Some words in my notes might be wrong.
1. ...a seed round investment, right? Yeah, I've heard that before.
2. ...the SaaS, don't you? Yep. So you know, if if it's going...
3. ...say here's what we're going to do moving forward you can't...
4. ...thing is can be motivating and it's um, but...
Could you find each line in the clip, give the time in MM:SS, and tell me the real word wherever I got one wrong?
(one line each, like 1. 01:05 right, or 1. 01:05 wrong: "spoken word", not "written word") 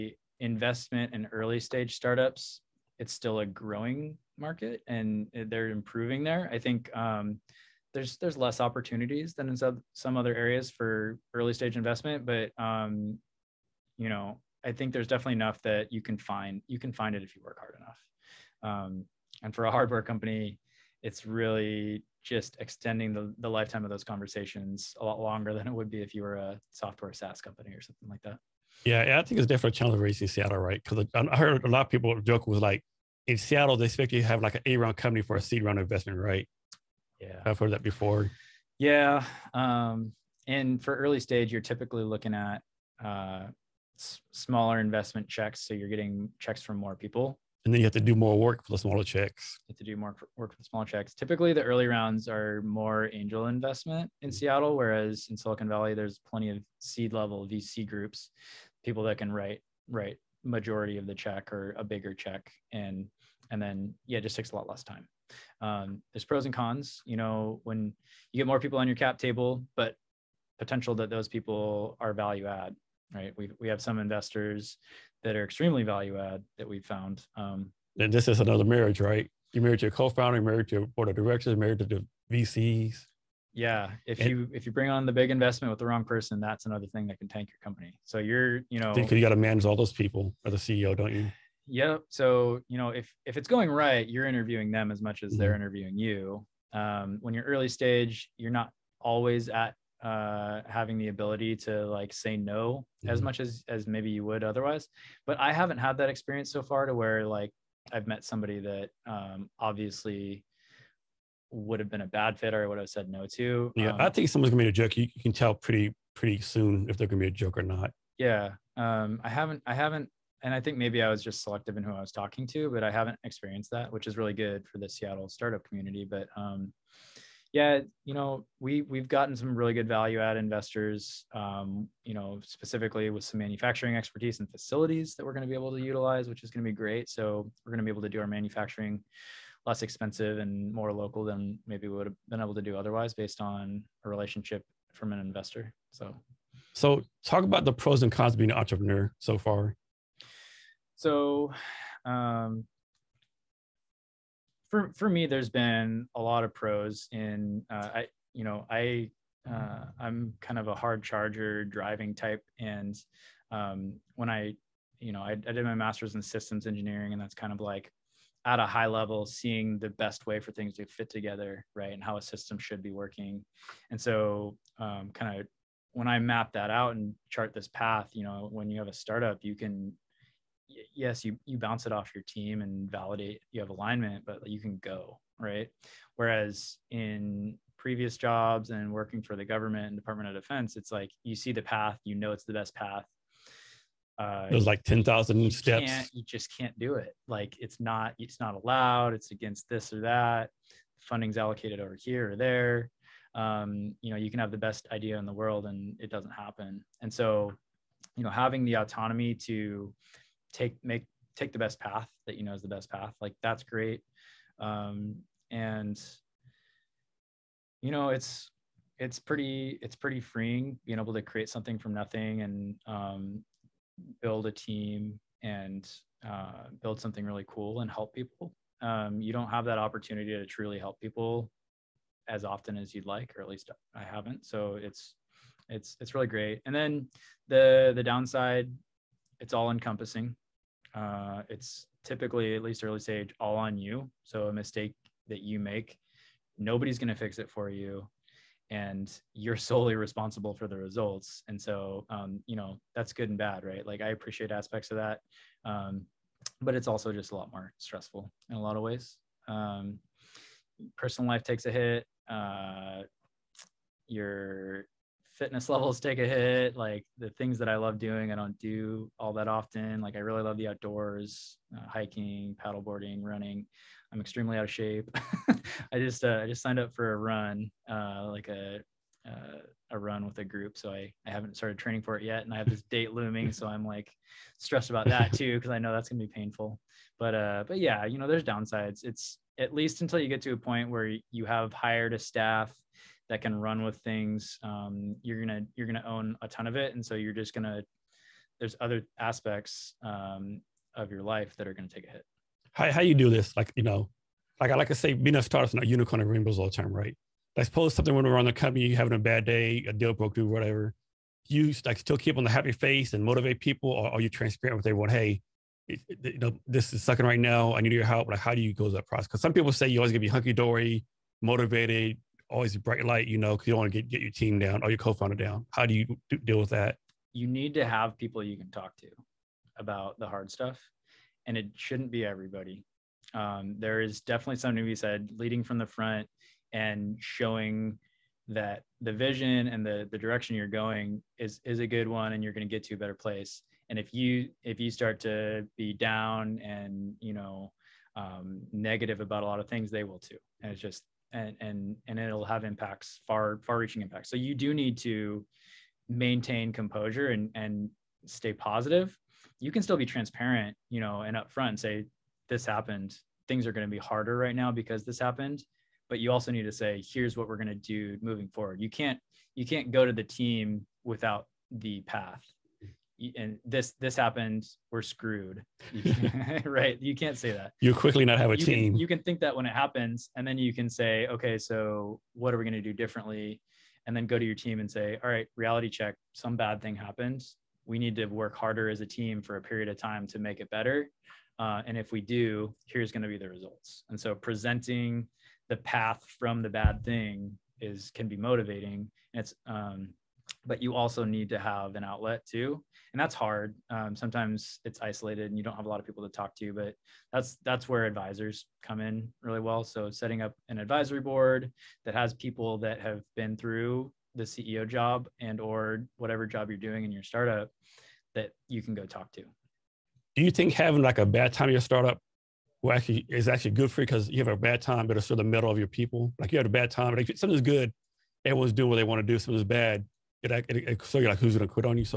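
1. 00:35 right
2. 01:30 wrong: "CEO", not "SaaS"
3. 06:06 right
4. 06:37 right.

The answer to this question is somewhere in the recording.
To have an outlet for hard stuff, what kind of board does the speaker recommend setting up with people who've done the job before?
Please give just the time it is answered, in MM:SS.
06:50.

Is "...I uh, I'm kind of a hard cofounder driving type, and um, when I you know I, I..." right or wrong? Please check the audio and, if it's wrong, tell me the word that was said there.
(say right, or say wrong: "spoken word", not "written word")
wrong: "charger", not "cofounder".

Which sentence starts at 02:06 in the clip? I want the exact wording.
But um, yeah, you know, we we've gotten some really good value add investors.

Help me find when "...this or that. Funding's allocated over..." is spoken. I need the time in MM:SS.
03:19.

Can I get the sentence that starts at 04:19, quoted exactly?
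Um, personal life takes a hit.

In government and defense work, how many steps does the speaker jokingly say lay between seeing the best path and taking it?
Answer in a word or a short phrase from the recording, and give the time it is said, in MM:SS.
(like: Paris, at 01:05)
10,000, at 03:14.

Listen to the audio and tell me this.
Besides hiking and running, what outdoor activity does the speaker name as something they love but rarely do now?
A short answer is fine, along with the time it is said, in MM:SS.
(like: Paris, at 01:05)
paddleboarding, at 04:32.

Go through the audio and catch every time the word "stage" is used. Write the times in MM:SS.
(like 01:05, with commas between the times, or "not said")
00:01, 00:11, 00:41, 01:37, 04:03.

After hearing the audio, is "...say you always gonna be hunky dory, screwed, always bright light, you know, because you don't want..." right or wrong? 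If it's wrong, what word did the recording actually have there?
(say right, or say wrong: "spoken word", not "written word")
wrong: "motivated", not "screwed".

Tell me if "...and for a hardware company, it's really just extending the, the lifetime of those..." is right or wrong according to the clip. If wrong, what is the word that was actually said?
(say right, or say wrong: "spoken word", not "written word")
right.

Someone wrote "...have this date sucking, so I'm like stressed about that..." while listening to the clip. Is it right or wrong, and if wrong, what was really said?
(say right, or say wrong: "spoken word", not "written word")
wrong: "looming", not "sucking".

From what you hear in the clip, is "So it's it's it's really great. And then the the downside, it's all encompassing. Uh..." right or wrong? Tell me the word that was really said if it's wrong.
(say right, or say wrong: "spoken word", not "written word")
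right.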